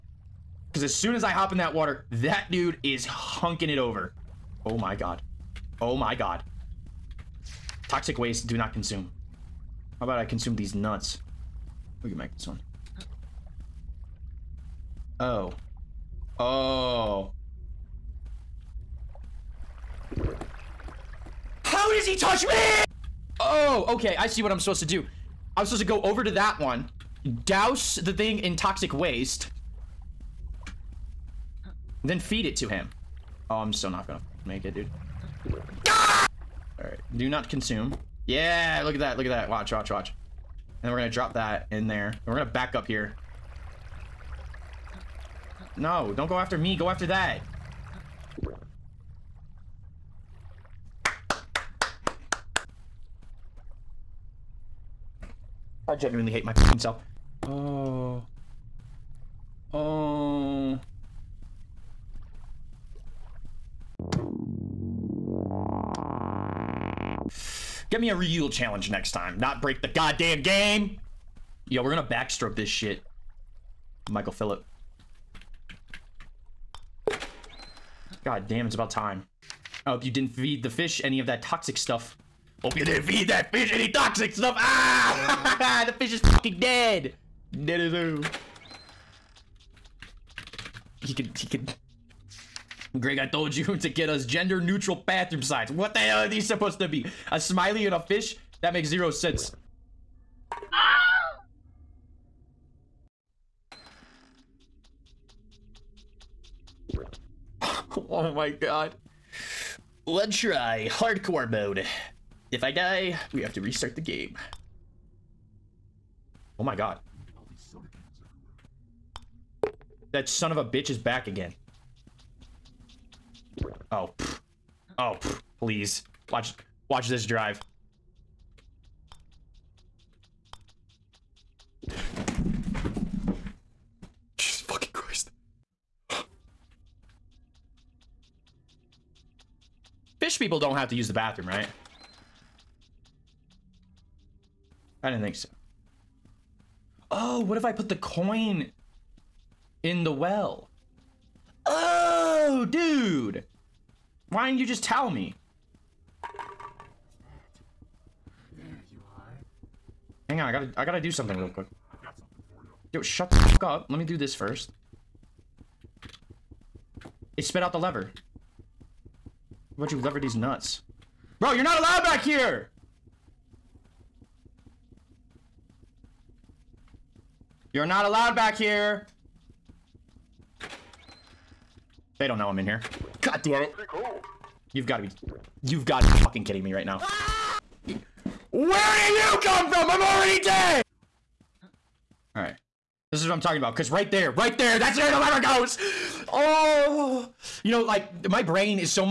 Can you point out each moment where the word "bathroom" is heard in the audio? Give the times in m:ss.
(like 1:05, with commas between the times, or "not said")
1:35, 2:21.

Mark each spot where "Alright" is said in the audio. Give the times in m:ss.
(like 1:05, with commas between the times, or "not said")
0:36, 3:12.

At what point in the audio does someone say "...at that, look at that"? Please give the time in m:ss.
0:38.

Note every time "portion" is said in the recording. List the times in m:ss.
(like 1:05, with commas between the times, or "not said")
not said.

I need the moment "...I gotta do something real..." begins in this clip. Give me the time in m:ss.
2:40.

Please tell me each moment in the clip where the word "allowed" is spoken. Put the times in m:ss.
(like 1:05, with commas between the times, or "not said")
2:51, 2:58.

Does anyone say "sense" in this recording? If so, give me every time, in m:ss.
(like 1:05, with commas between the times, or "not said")
1:39.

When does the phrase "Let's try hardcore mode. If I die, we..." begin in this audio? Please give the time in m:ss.
1:50.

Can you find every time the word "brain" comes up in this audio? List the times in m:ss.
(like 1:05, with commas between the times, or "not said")
3:18.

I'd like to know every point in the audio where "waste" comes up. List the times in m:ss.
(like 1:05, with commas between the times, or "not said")
0:08, 0:28.